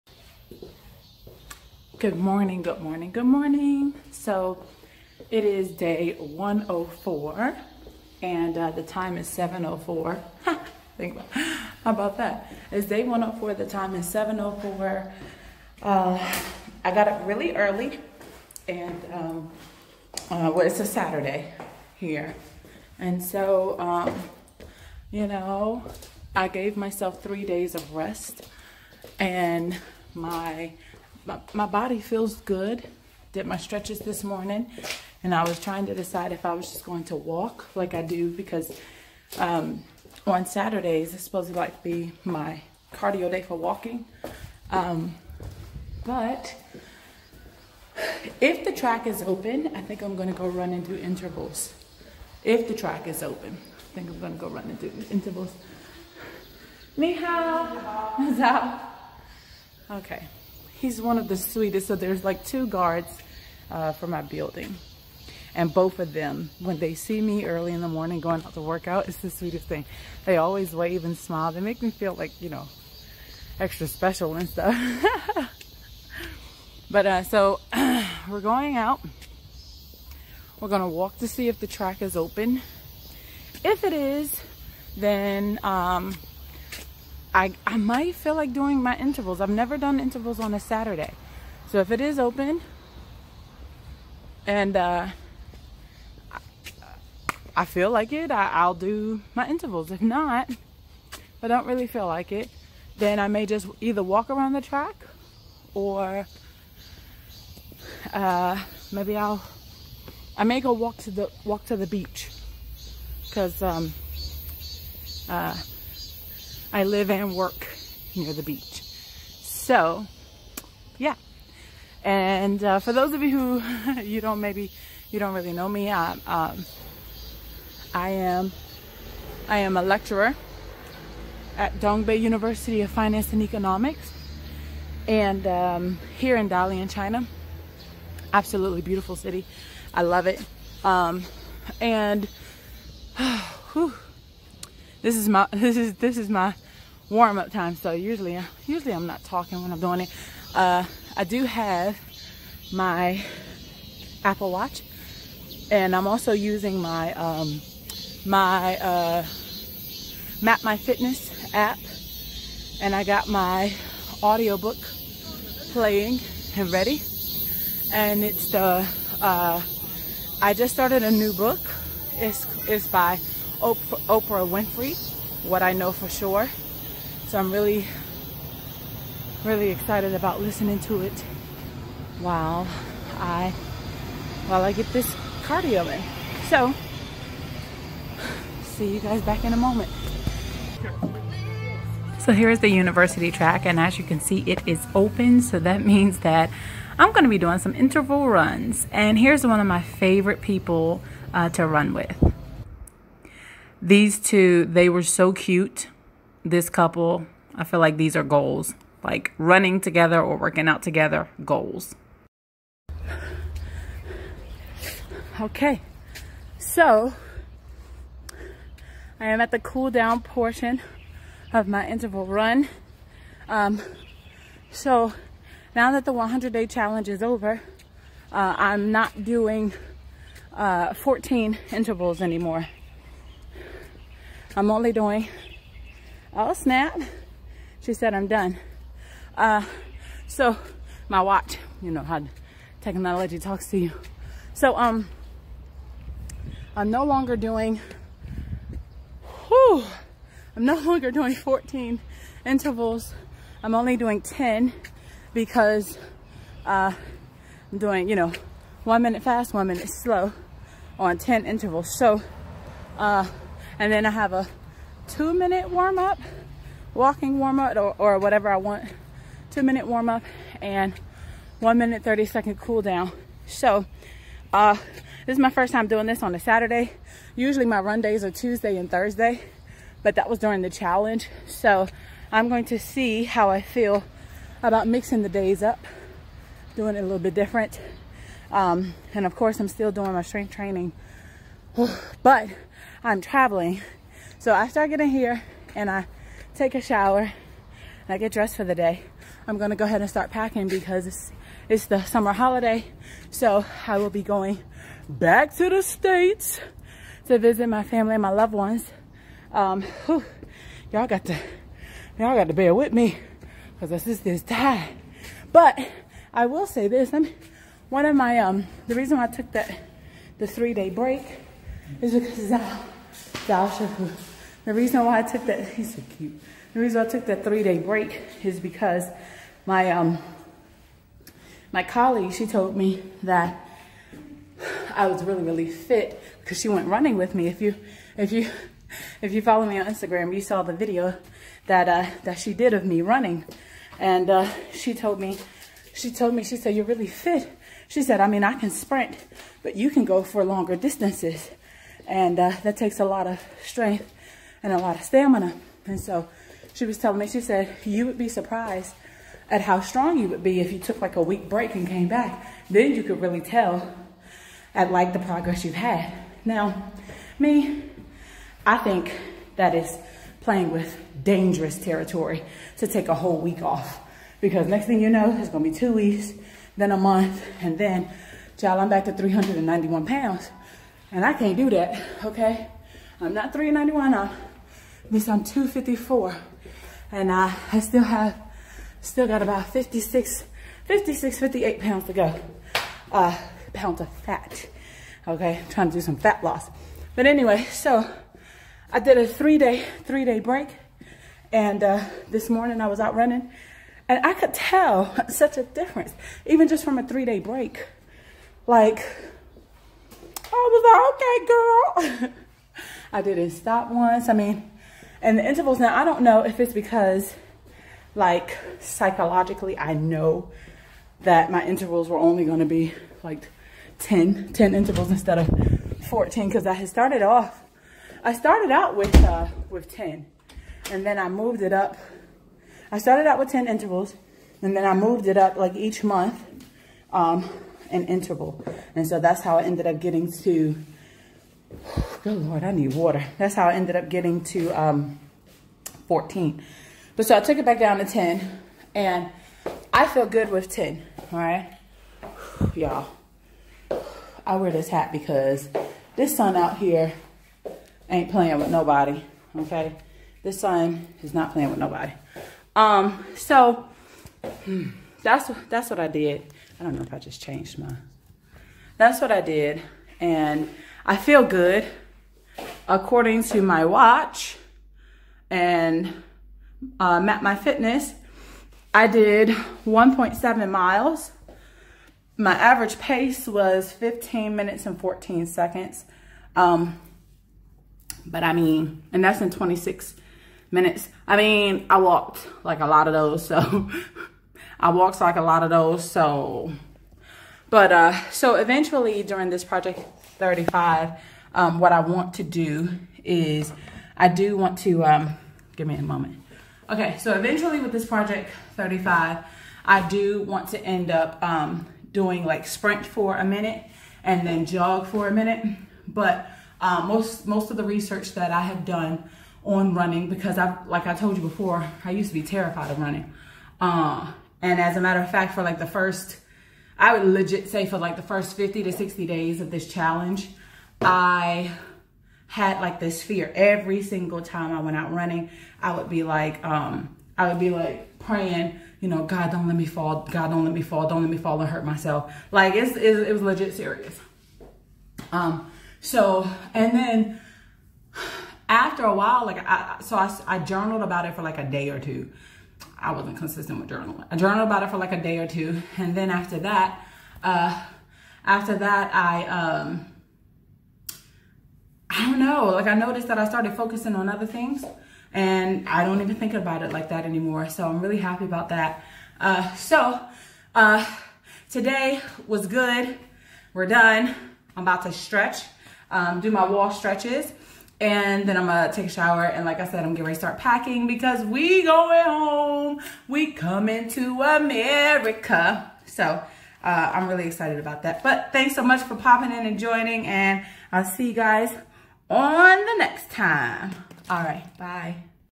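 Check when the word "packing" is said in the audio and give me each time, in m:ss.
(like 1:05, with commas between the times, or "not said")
5:00, 9:40.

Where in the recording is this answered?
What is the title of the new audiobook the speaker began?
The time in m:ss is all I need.
2:55.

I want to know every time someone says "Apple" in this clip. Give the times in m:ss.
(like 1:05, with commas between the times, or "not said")
2:34.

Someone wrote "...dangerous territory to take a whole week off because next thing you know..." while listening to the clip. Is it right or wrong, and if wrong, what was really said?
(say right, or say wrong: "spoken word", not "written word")
right.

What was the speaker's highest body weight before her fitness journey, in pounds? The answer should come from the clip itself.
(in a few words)
391.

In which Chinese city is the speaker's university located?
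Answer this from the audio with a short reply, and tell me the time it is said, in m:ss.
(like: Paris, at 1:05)
Dalian, at 2:16.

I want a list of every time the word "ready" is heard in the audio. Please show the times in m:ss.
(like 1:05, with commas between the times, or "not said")
2:46, 9:40.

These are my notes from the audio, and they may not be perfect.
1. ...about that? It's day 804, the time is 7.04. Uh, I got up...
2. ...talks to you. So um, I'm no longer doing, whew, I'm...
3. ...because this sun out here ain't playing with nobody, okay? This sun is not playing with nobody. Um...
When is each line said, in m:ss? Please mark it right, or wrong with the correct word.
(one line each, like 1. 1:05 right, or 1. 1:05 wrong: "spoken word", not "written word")
1. 0:11 wrong: "104", not "804"
2. 4:03 right
3. 7:35 right.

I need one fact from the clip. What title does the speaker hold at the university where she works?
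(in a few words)
Lecturer.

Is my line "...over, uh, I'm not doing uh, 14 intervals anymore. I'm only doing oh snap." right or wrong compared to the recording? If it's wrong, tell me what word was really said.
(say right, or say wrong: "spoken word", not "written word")
right.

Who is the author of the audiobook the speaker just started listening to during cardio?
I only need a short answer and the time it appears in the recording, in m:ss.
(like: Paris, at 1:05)
Oprah Winfrey, at 2:53.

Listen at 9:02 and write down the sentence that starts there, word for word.
Like it's, it's it was legit serious.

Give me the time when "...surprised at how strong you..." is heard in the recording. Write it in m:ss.
5:58.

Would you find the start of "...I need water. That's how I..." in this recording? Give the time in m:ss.
7:22.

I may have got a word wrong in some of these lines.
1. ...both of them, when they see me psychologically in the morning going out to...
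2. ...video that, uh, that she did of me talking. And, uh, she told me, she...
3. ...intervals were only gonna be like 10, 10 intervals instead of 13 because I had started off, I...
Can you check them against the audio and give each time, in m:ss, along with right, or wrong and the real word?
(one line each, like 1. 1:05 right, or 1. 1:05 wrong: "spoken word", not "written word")
1. 1:05 wrong: "early", not "psychologically"
2. 5:40 wrong: "running", not "talking"
3. 7:01 wrong: "14", not "13".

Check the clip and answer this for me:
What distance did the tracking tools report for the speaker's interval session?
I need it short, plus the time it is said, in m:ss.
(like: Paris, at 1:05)
1.7 miles, at 7:59.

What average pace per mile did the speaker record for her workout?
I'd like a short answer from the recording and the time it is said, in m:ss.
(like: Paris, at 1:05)
15 minutes 14 seconds, at 8:03.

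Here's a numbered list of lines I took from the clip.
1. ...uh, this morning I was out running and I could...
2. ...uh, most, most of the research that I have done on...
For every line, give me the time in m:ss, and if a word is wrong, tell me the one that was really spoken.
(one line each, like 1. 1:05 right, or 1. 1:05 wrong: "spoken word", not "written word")
1. 6:41 right
2. 8:36 right.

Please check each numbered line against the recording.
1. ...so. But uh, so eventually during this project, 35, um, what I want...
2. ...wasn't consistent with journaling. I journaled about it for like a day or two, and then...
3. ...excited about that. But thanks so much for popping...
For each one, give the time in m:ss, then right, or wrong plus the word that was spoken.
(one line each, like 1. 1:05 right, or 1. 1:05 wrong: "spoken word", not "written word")
1. 8:16 right
2. 9:13 right
3. 9:47 right.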